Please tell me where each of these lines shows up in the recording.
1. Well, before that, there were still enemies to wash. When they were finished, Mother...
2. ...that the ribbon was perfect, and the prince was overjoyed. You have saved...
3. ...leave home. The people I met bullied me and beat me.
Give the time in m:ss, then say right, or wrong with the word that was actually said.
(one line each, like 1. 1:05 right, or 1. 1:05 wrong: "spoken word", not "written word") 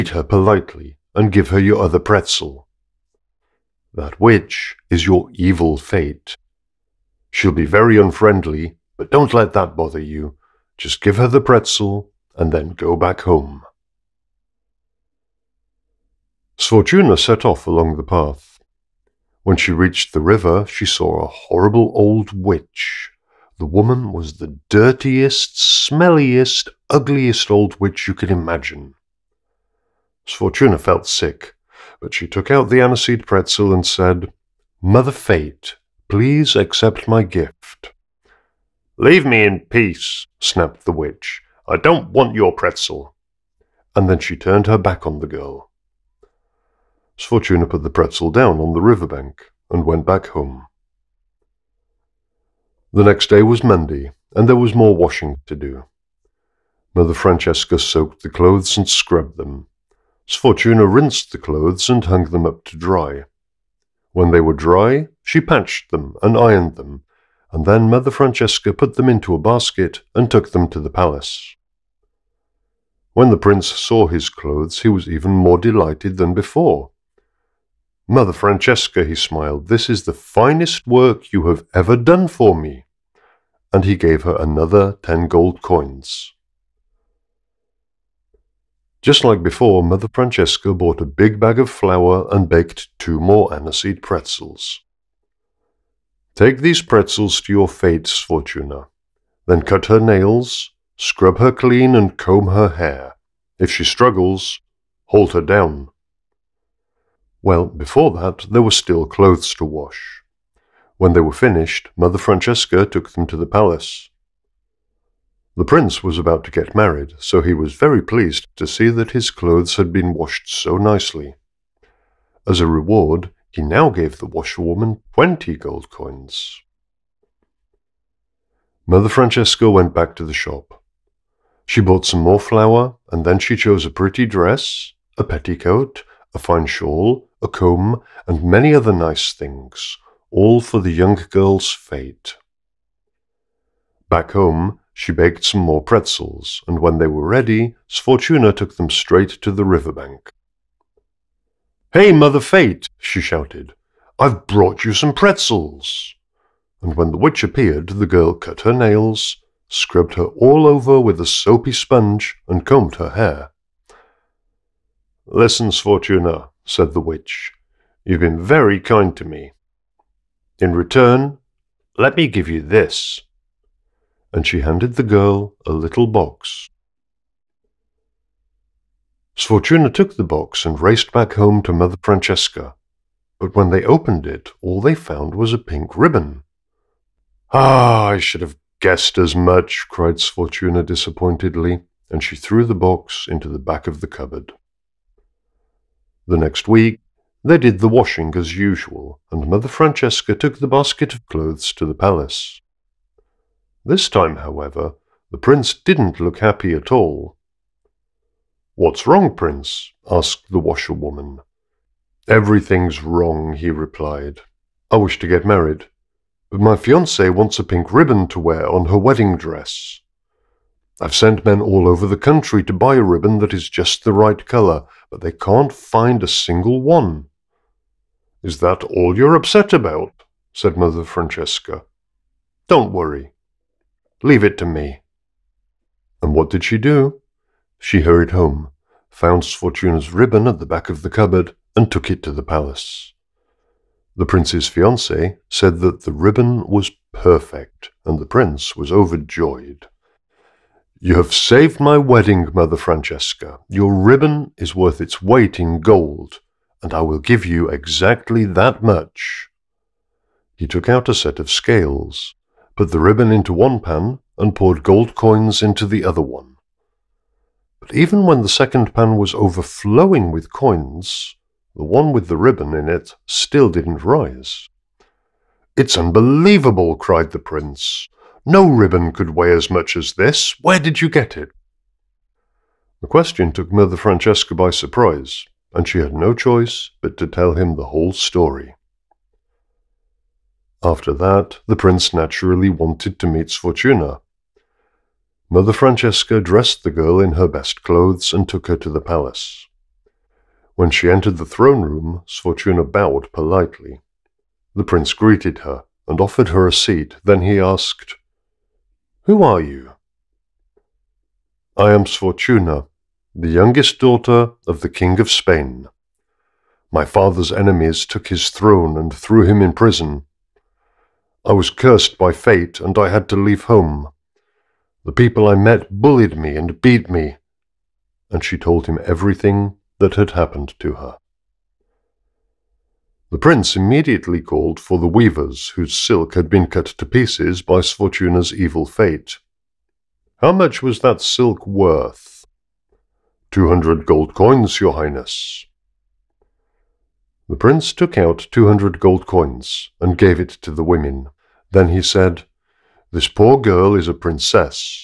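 1. 1:47 wrong: "clothes", not "enemies"
2. 4:05 right
3. 5:23 right.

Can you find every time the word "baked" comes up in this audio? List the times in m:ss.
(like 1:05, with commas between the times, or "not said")
1:32, 2:25.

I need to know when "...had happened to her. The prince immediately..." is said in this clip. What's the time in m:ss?
5:30.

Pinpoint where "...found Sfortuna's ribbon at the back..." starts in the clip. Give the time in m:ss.
3:59.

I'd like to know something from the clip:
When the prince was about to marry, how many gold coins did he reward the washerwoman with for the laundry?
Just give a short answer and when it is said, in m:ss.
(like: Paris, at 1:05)
20, at 2:05.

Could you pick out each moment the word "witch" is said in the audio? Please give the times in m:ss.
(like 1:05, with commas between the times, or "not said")
0:04, 0:22, 0:27, 0:40, 2:37, 2:47.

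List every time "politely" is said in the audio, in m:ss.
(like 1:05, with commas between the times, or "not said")
0:00, 5:03.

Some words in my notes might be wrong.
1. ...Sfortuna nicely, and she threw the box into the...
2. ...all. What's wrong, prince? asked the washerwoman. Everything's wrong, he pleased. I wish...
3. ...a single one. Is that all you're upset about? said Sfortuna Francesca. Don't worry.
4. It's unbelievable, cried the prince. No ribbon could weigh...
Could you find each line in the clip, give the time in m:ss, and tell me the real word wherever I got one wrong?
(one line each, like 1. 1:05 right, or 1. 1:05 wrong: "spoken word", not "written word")
1. 3:10 wrong: "disappointedly", not "nicely"
2. 3:26 wrong: "replied", not "pleased"
3. 3:46 wrong: "Mother", not "Sfortuna"
4. 4:35 right.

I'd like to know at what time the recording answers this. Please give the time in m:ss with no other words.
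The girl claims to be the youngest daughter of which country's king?
5:15.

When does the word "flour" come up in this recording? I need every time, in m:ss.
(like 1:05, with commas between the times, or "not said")
1:31, 2:12.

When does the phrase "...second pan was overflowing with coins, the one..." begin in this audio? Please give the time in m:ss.
4:28.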